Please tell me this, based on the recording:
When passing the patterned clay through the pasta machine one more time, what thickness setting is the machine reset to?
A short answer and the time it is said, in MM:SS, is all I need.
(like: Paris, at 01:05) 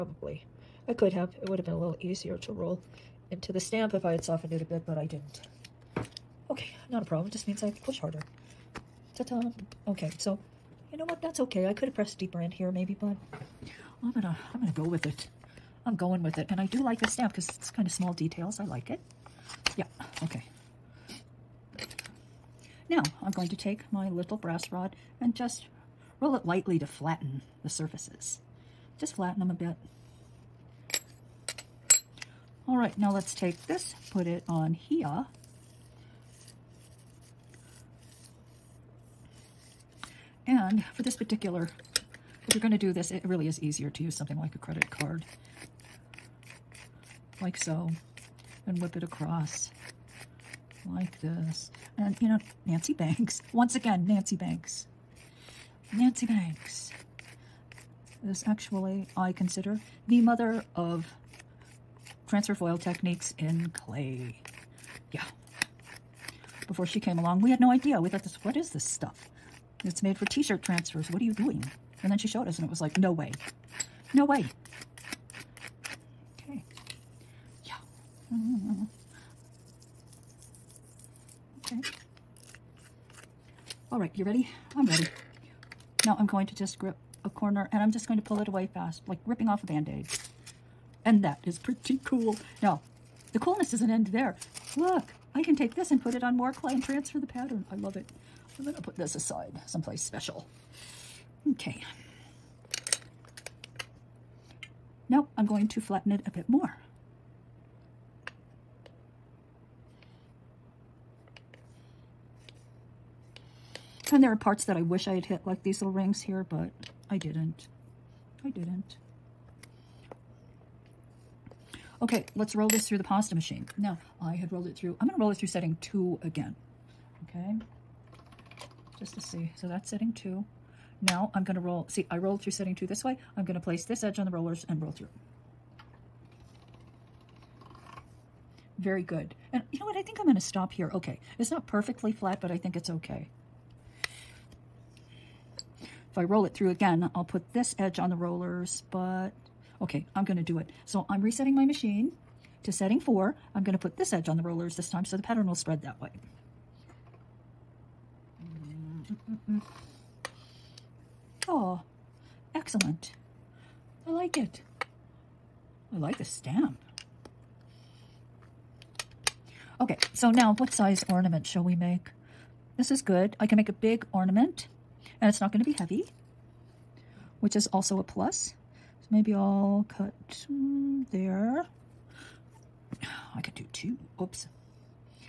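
4, at 02:32.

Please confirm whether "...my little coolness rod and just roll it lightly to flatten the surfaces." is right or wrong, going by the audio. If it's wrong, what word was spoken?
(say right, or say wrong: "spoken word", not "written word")
wrong: "brass", not "coolness".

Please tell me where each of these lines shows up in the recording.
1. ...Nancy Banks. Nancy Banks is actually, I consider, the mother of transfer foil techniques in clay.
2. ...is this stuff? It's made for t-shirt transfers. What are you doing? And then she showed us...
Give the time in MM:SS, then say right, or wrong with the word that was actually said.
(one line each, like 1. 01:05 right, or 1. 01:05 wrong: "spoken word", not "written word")
1. 00:54 right
2. 01:08 right.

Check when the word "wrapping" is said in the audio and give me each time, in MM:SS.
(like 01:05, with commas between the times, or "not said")
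not said.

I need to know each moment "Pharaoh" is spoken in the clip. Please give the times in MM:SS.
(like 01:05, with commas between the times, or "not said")
not said.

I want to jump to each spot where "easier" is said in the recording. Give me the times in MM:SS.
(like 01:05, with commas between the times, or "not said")
00:02, 00:43.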